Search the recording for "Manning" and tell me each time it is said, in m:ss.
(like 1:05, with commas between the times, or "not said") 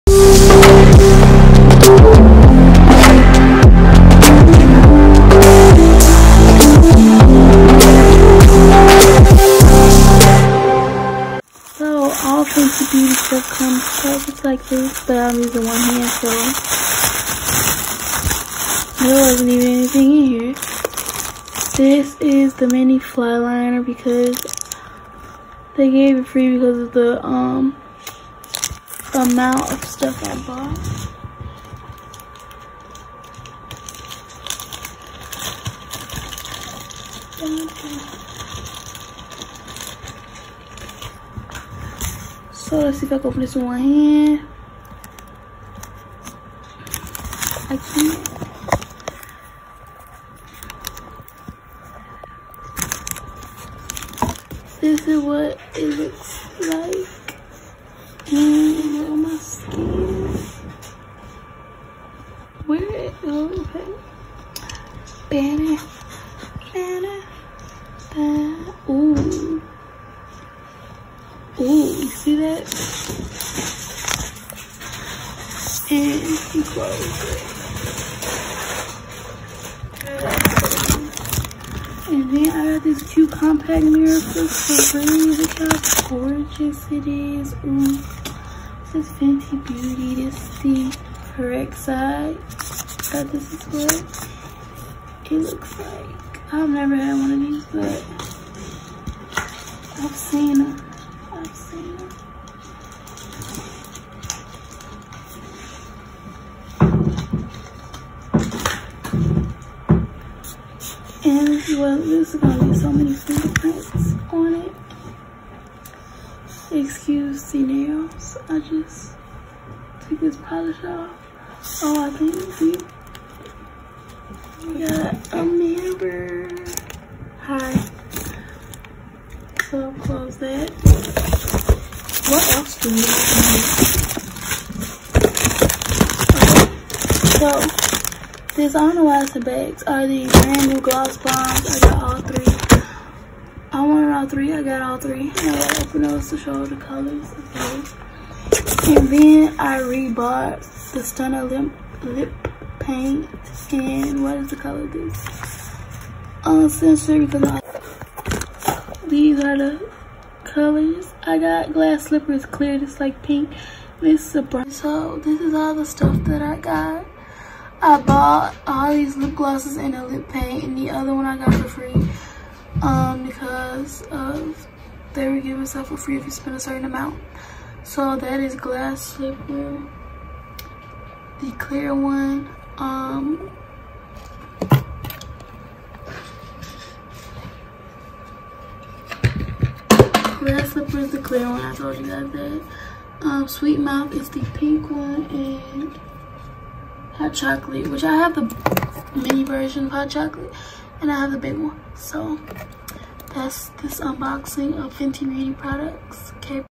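not said.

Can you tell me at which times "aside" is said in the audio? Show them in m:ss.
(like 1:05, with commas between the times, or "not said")
not said.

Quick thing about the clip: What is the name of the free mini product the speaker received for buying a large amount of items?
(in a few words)
Flyliner.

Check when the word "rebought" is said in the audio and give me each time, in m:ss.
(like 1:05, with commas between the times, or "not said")
2:29.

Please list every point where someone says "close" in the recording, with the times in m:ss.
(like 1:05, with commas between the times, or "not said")
1:16, 2:10.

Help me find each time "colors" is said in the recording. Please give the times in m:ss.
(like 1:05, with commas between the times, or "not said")
2:26, 2:34, 2:40.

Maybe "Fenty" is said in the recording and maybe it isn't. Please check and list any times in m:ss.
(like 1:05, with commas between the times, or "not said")
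1:29, 3:24.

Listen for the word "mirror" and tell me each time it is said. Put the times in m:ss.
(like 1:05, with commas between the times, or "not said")
1:23, 2:05.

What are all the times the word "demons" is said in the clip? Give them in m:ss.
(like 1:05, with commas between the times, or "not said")
not said.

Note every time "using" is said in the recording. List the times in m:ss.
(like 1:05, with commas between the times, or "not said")
0:15.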